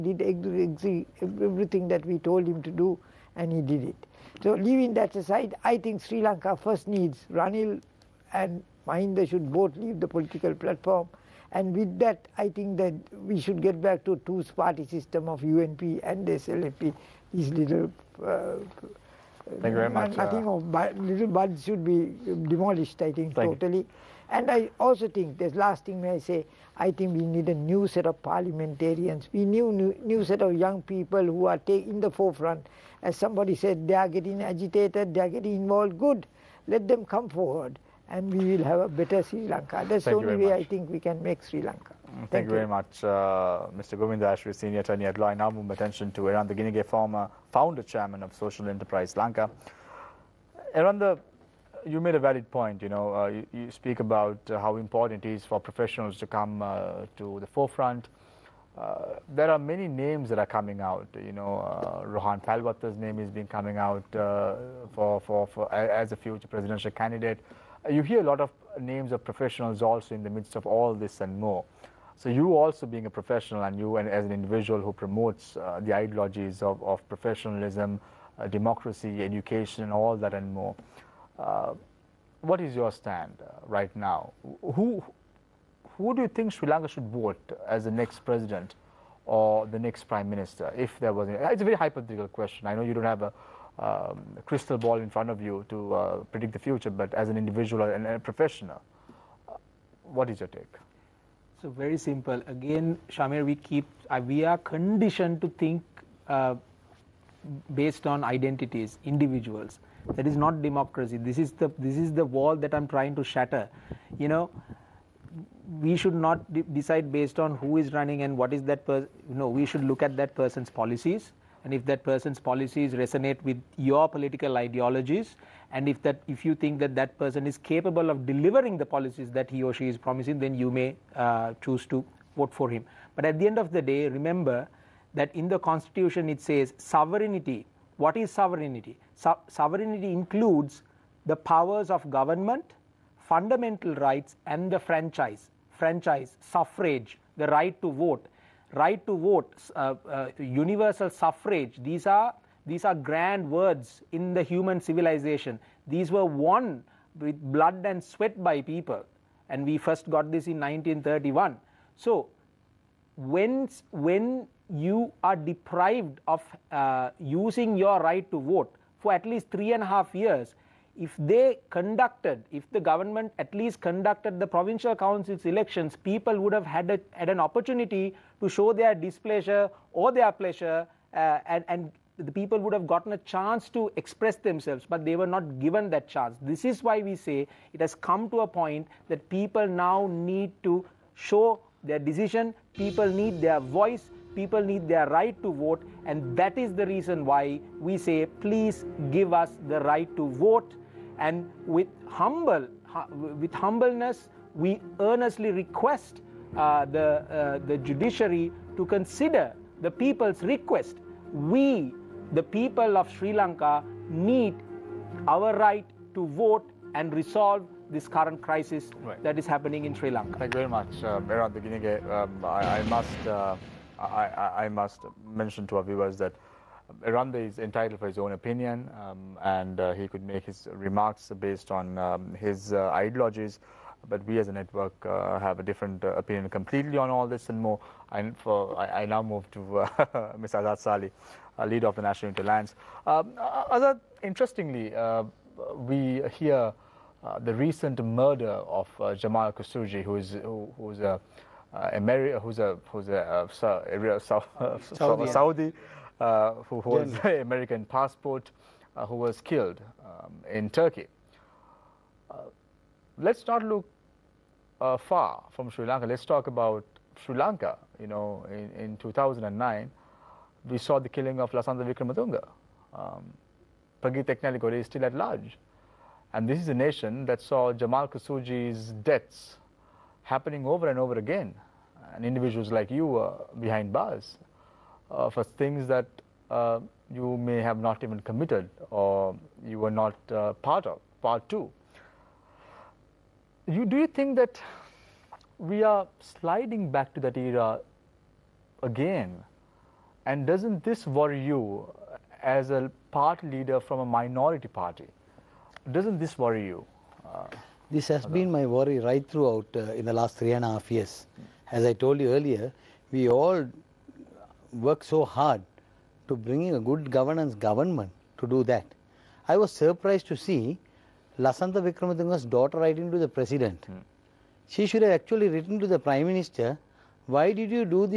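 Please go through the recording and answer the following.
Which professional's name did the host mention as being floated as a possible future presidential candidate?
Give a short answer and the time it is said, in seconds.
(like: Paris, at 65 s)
Rohan Pallewatte, at 62 s.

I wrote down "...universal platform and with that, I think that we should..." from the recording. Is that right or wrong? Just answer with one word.
wrong.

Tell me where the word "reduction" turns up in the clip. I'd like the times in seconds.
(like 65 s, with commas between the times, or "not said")
not said.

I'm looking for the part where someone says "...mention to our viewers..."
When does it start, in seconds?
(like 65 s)
225 s.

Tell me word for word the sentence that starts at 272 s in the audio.
Um, Prageeth is still at large.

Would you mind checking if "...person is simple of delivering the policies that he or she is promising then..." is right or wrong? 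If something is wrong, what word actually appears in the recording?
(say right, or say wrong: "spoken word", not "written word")
wrong: "capable", not "simple".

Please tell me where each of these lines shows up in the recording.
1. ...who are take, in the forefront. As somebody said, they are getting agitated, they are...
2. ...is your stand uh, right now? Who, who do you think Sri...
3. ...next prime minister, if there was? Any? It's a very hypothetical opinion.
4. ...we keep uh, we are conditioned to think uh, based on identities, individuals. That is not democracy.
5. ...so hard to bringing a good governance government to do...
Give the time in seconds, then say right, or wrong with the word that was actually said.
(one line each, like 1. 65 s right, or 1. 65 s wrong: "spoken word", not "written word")
1. 31 s right
2. 82 s right
3. 89 s wrong: "question", not "opinion"
4. 103 s right
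5. 315 s right.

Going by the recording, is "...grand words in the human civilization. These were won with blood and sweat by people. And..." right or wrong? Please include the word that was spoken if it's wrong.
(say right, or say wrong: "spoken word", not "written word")
right.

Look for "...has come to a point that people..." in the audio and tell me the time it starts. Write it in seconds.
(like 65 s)
187 s.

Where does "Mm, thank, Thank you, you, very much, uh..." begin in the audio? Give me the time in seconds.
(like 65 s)
41 s.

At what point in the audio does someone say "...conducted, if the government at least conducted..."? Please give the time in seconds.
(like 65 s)
171 s.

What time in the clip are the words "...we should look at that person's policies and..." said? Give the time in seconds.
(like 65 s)
119 s.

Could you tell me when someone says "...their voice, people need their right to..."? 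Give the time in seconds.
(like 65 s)
193 s.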